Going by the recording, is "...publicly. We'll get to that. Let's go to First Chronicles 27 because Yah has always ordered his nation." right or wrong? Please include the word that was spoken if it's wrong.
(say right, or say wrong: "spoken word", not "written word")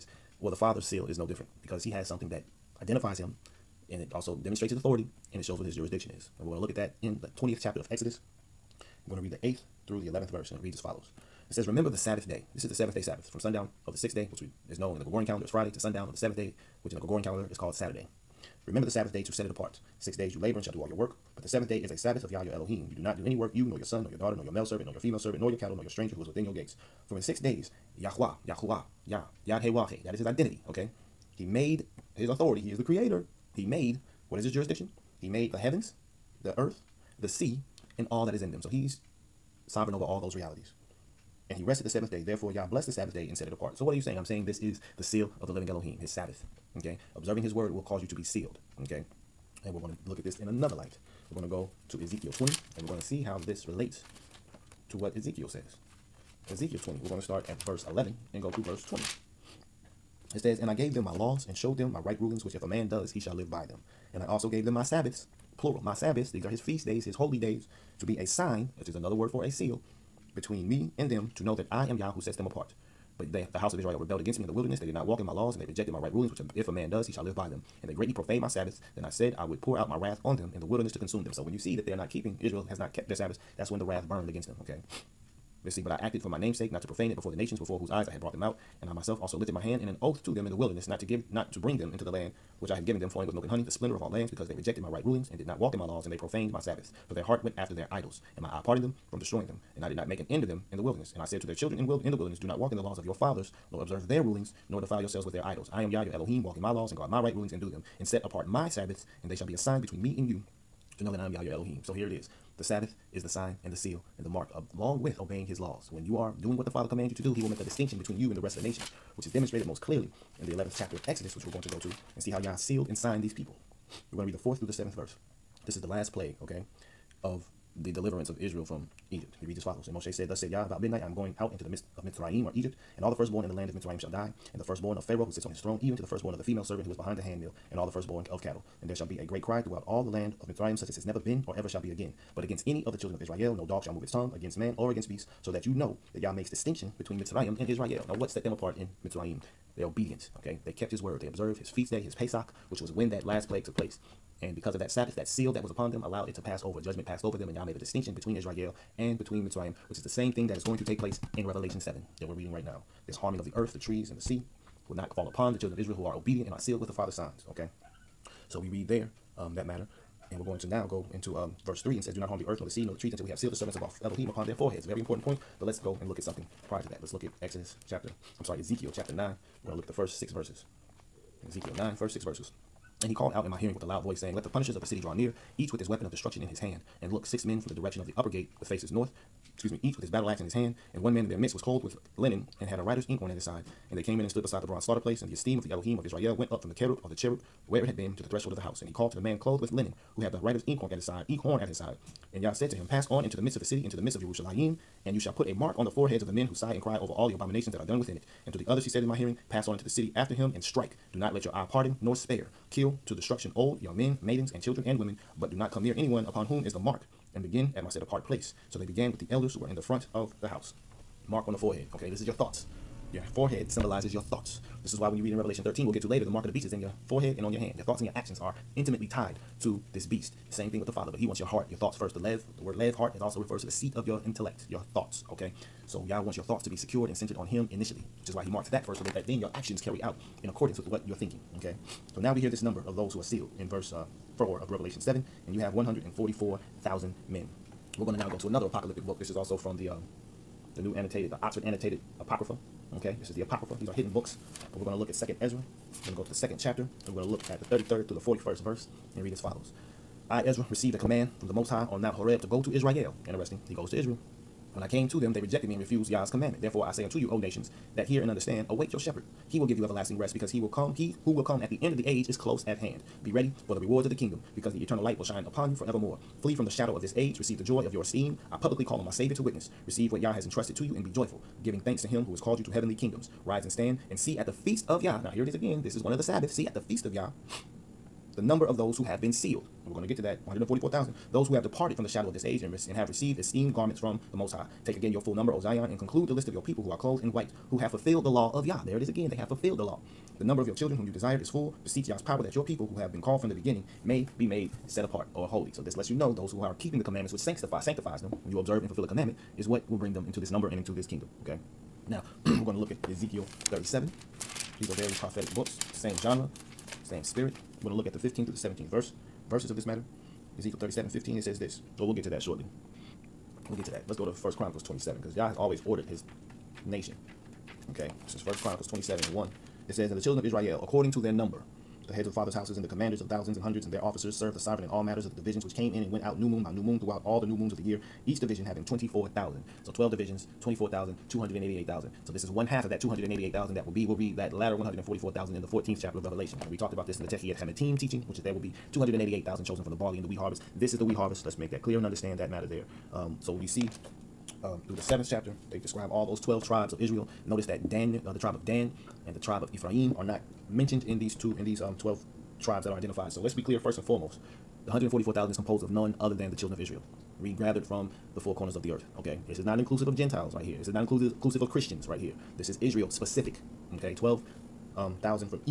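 wrong: "shortly", not "publicly".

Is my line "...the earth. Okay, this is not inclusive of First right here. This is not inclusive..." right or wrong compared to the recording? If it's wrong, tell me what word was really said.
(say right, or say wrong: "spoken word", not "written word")
wrong: "Gentiles", not "First".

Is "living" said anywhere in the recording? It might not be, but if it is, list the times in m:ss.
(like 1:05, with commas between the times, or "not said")
0:45.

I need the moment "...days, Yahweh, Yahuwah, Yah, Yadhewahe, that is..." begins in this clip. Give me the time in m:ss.
0:27.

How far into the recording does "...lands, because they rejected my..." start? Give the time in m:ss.
1:34.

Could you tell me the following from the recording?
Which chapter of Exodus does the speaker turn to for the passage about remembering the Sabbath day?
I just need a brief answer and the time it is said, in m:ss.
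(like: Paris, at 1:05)
20th chapter, at 0:07.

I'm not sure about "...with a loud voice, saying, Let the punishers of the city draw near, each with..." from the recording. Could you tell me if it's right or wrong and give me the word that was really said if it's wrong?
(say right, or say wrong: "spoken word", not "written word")
right.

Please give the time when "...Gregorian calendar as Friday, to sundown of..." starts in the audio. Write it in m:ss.
0:15.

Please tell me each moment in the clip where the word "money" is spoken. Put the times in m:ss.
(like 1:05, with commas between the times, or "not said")
not said.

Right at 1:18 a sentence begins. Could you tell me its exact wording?
Then I said I would pour out my wrath on them in the wilderness to consume them.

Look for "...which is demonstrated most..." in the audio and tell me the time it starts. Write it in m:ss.
1:59.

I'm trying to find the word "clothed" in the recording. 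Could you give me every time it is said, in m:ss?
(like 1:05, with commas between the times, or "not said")
3:11, 3:19, 4:56.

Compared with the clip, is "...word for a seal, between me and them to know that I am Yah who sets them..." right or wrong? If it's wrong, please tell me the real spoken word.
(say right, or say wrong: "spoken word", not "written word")
right.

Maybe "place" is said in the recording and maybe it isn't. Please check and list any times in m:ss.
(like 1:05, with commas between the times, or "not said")
2:33, 2:40, 3:14, 3:38.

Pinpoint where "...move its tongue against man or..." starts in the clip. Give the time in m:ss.
2:23.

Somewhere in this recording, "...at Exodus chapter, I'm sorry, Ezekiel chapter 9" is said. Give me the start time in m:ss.
2:57.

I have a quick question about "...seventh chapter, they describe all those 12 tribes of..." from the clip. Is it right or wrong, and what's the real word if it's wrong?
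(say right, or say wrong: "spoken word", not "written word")
right.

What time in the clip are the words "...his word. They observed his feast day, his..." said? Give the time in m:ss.
2:30.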